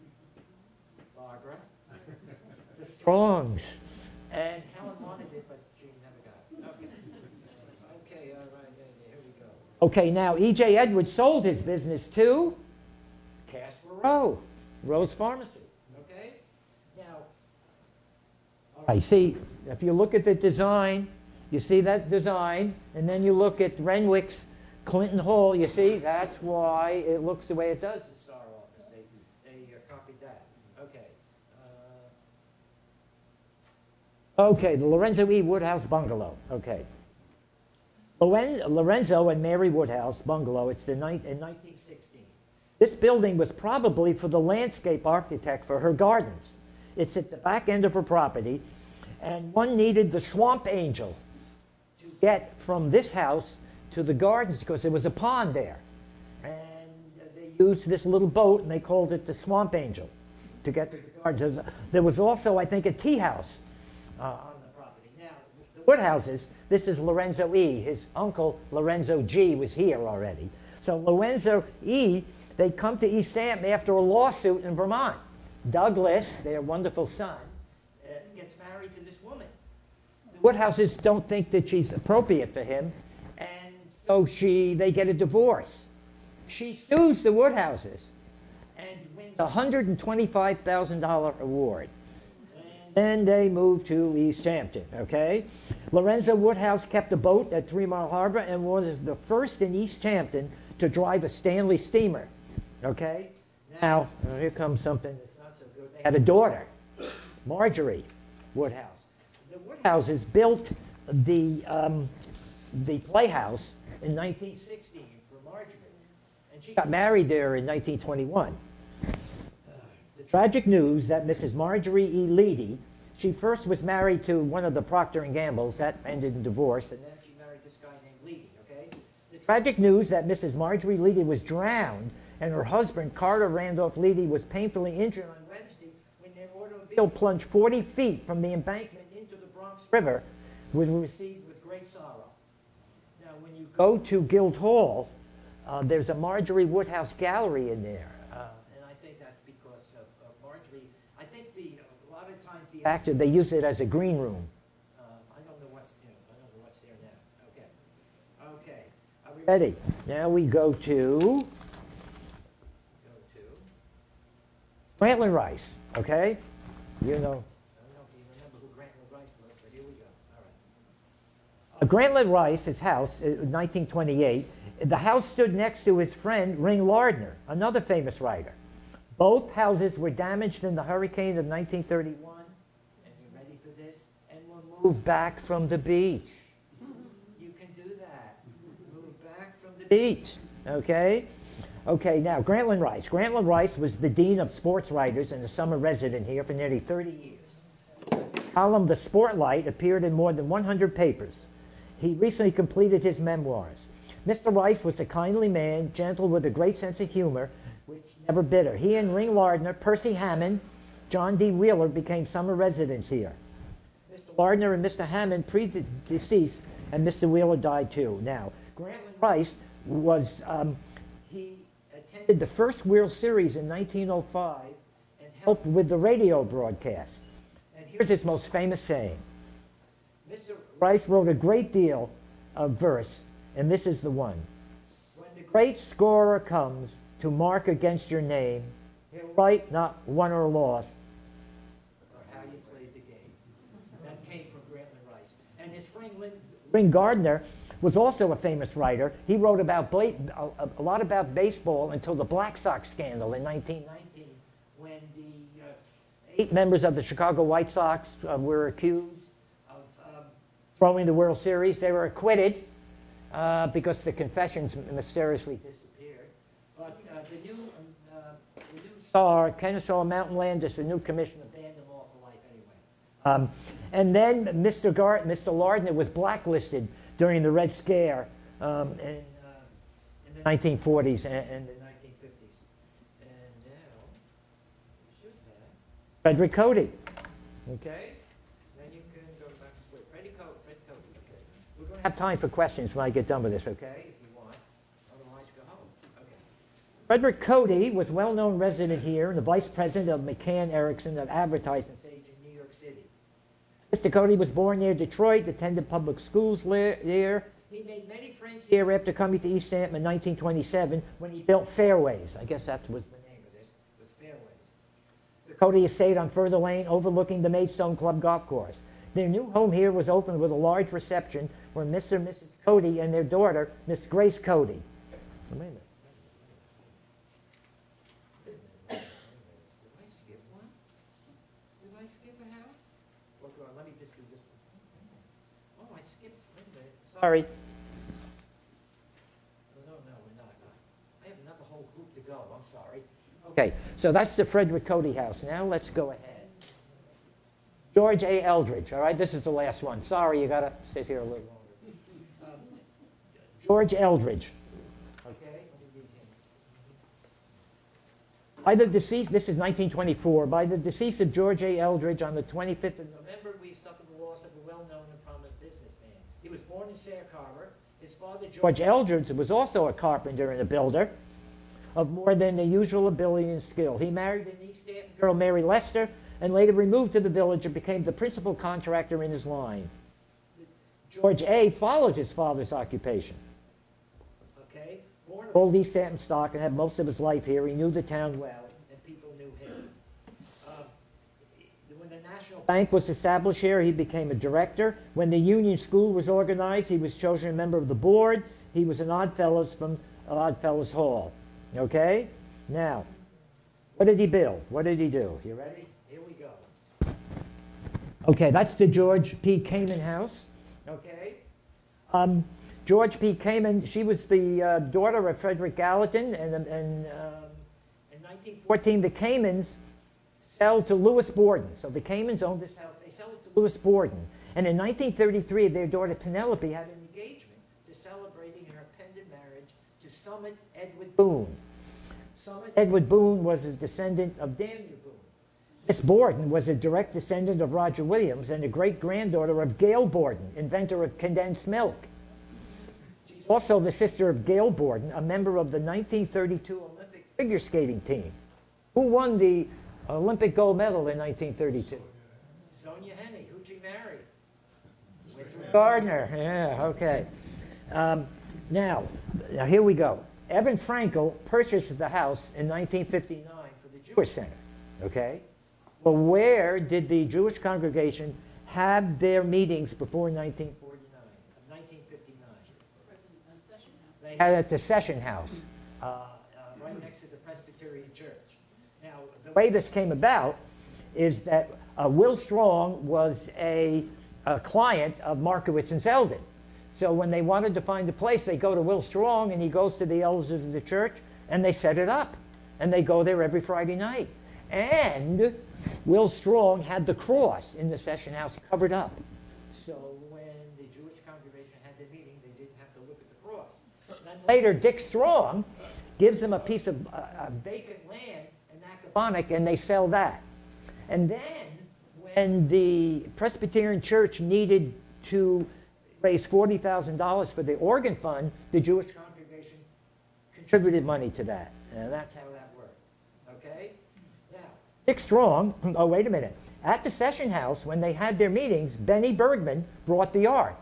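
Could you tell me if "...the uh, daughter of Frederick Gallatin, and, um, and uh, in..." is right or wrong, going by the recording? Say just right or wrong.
right.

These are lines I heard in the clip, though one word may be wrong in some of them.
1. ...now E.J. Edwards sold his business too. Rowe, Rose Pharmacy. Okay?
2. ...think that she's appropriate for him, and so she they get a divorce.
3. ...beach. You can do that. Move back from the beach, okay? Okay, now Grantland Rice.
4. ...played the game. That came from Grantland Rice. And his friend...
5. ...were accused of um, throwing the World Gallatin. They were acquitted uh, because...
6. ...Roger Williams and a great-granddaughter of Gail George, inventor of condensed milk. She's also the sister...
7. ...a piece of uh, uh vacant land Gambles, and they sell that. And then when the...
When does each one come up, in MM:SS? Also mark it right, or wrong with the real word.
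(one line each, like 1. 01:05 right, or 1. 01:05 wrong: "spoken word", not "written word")
1. 00:10 right
2. 01:21 right
3. 03:05 right
4. 04:02 right
5. 04:18 wrong: "Series", not "Gallatin"
6. 07:17 wrong: "Borden", not "George"
7. 08:26 wrong: "Symphonic", not "Gambles".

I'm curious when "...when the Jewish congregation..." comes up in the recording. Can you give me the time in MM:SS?
08:20.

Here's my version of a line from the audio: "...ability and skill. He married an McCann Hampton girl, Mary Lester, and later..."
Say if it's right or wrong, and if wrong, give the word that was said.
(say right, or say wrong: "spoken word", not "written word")
wrong: "East", not "McCann".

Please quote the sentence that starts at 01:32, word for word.
Then they moved to East Hampton, okay?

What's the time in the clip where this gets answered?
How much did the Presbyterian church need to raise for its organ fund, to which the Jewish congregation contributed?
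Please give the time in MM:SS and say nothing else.
08:36.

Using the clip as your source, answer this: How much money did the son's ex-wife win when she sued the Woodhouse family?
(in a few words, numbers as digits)
$125,000.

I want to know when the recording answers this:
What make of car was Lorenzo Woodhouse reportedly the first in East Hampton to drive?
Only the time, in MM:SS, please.
01:41.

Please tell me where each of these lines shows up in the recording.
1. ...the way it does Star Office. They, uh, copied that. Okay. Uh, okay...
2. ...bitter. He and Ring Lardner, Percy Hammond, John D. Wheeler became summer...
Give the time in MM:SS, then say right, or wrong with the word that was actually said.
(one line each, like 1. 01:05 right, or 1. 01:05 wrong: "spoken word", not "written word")
1. 00:27 right
2. 03:28 right.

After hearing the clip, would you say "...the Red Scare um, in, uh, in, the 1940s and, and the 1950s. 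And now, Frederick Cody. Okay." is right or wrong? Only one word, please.
right.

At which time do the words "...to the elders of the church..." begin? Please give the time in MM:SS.
08:09.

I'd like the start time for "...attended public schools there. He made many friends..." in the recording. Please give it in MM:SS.
05:05.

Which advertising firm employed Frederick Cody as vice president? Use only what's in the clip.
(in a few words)
McCann Erickson.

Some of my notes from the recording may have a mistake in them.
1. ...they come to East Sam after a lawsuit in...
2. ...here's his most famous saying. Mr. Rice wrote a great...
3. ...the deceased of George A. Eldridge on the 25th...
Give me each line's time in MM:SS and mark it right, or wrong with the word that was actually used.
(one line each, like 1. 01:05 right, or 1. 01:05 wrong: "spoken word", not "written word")
1. 01:12 right
2. 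03:47 right
3. 06:00 right.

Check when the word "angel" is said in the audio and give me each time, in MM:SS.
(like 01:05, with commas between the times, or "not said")
00:50, 00:59.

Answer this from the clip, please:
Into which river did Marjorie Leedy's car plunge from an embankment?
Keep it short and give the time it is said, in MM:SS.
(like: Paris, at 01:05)
Bronx River, at 02:19.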